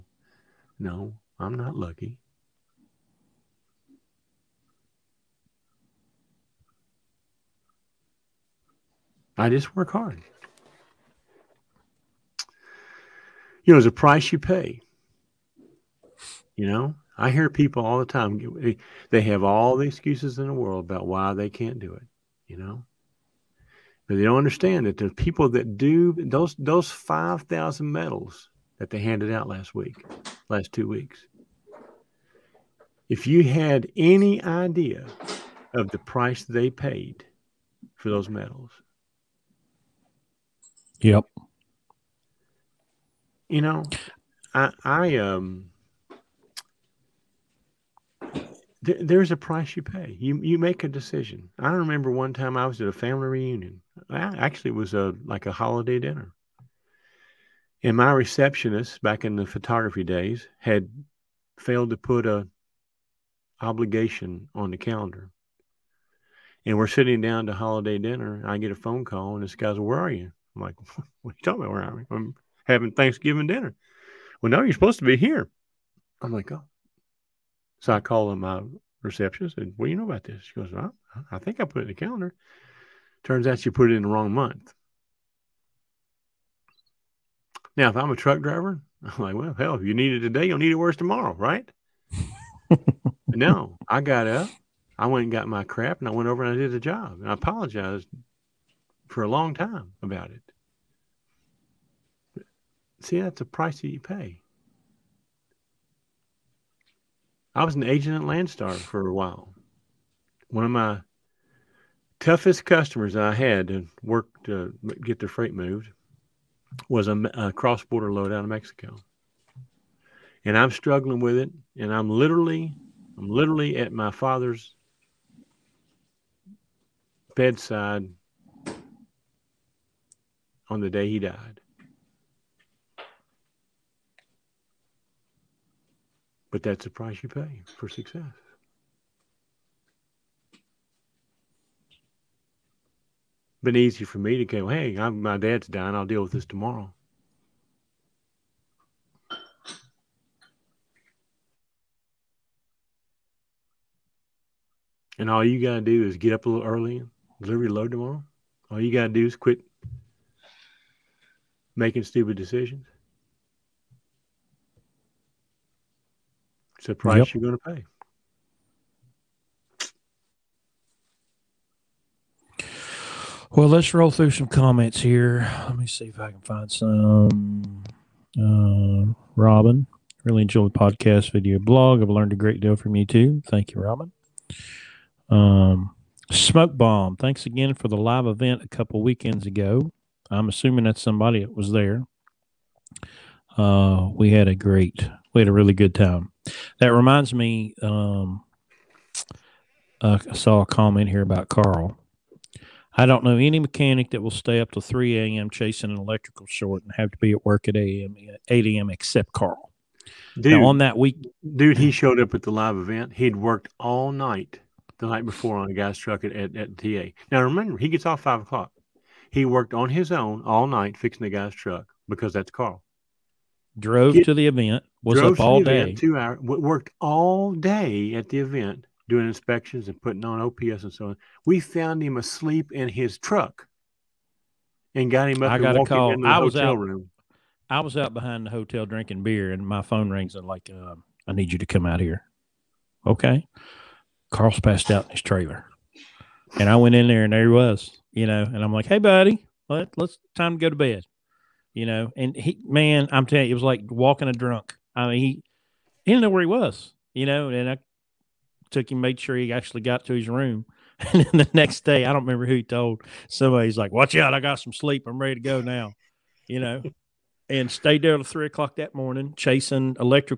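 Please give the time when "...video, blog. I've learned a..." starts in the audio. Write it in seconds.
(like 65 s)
181 s.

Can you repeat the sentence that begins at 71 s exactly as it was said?
Where I'm, I'm having Thanksgiving dinner.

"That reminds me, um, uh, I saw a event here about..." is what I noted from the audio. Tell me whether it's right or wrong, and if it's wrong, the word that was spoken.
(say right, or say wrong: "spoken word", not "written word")
wrong: "comment", not "event".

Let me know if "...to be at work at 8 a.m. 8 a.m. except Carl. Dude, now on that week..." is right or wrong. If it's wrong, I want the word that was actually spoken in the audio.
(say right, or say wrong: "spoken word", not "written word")
right.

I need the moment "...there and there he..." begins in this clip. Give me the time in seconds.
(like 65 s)
247 s.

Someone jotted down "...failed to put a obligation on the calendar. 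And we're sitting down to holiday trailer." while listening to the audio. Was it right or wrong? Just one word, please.
wrong.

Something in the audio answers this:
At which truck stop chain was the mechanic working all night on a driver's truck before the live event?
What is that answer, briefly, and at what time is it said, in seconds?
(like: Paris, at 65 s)
TA, at 216 s.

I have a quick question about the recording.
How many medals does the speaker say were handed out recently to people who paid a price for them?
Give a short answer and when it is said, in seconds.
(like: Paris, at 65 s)
5000, at 26 s.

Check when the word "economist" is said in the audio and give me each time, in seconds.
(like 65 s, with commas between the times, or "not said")
not said.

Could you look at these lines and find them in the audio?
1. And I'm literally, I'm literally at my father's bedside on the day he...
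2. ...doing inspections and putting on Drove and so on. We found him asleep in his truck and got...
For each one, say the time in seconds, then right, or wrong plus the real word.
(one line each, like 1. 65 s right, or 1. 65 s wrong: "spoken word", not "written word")
1. 121 s right
2. 229 s wrong: "OPS", not "Drove".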